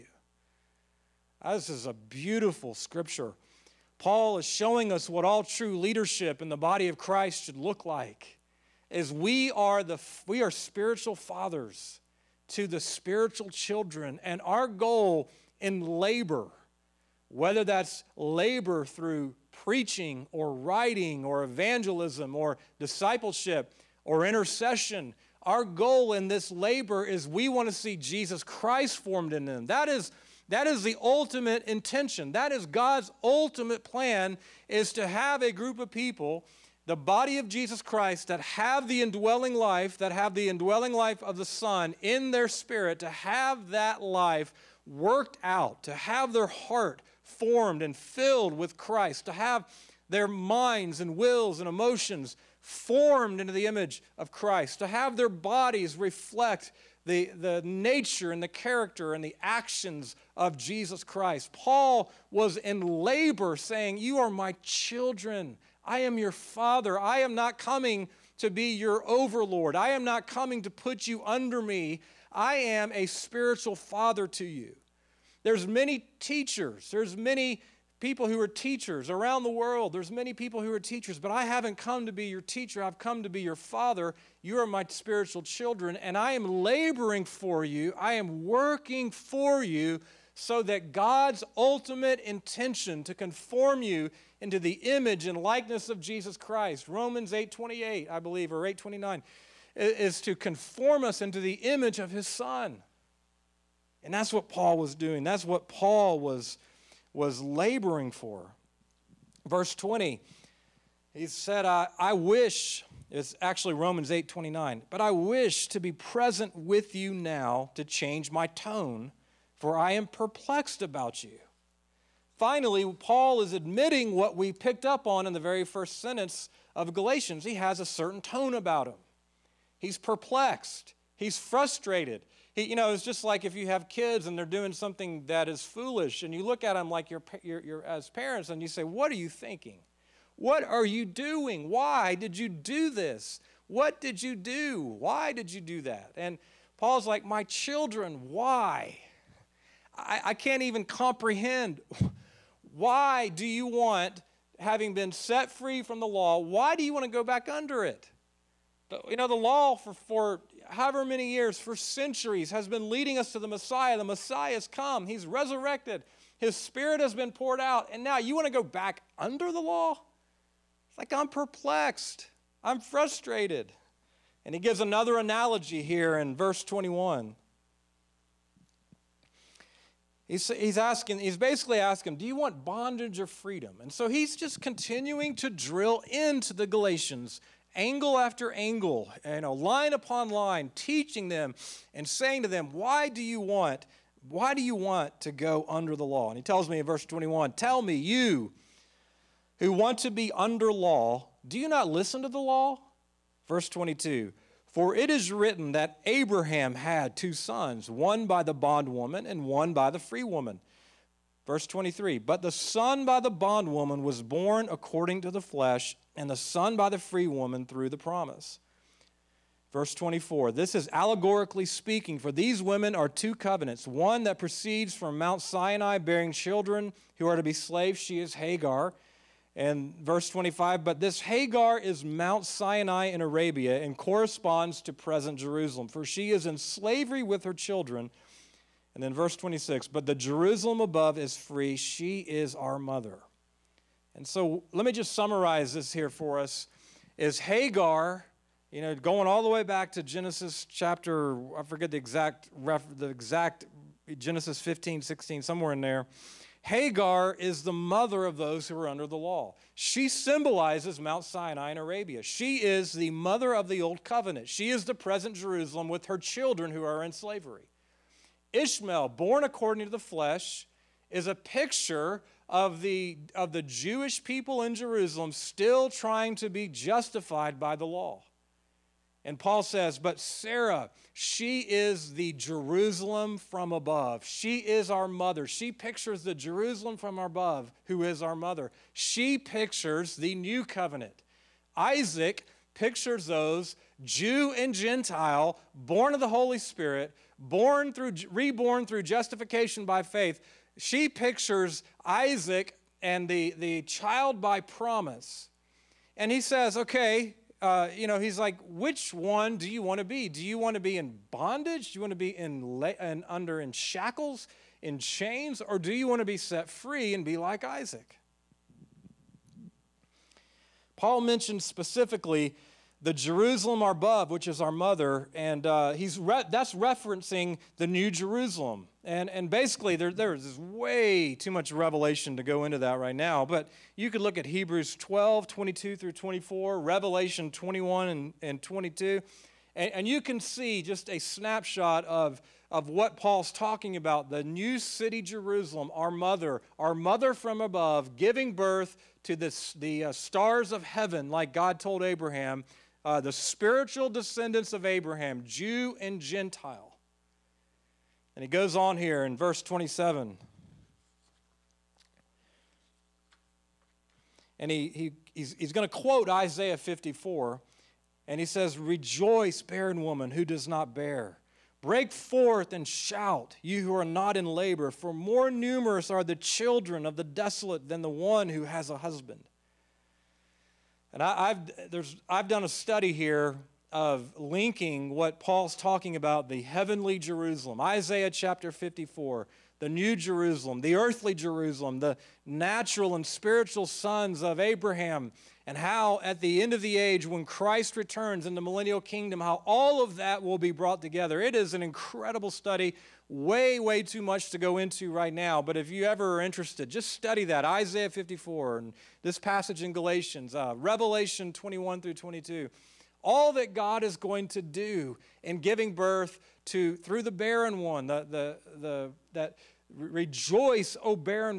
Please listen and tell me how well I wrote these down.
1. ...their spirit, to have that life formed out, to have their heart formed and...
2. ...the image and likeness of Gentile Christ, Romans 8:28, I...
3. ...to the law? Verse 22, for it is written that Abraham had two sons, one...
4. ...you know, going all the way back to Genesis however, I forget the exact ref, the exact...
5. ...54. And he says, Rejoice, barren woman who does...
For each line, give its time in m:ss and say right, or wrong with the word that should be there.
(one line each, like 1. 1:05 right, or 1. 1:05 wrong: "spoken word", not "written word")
1. 0:42 wrong: "worked", not "formed"
2. 1:34 wrong: "Jesus", not "Gentile"
3. 3:22 right
4. 4:08 wrong: "chapter", not "however"
5. 6:06 right.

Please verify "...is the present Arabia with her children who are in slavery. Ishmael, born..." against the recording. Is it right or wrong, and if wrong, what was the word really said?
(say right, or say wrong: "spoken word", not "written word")
wrong: "Jerusalem", not "Arabia".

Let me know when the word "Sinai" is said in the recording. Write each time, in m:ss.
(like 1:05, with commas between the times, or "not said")
3:45, 3:52, 4:21.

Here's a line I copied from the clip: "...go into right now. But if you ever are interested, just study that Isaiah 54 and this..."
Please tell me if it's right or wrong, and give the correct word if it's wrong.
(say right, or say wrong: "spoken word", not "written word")
right.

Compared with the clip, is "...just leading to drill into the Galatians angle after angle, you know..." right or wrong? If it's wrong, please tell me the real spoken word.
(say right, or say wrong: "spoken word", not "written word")
wrong: "continuing", not "leading".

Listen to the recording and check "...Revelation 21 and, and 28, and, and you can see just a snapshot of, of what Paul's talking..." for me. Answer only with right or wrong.
wrong.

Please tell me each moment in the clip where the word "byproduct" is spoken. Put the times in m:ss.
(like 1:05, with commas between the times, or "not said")
not said.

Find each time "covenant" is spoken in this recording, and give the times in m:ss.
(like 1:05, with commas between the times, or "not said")
3:43, 4:24, 4:50.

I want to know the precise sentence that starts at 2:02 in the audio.
Finally, Paul is admitting what we picked up on in the very first sentence of Galatians.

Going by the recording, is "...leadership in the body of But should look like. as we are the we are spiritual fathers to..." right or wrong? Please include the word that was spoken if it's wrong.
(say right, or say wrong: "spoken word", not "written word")
wrong: "Christ", not "But".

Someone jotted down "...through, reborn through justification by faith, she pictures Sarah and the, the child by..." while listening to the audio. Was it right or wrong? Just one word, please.
wrong.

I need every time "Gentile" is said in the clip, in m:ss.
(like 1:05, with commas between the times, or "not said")
4:54, 5:56.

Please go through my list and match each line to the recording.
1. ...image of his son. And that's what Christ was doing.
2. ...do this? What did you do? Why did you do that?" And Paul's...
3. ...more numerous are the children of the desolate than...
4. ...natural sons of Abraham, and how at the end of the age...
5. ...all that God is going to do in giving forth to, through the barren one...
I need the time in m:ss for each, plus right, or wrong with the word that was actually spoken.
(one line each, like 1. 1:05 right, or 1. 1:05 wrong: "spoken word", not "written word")
1. 1:41 wrong: "Paul", not "Christ"
2. 2:22 right
3. 6:15 right
4. 6:33 wrong: "spiritual", not "natural"
5. 6:53 wrong: "birth", not "forth".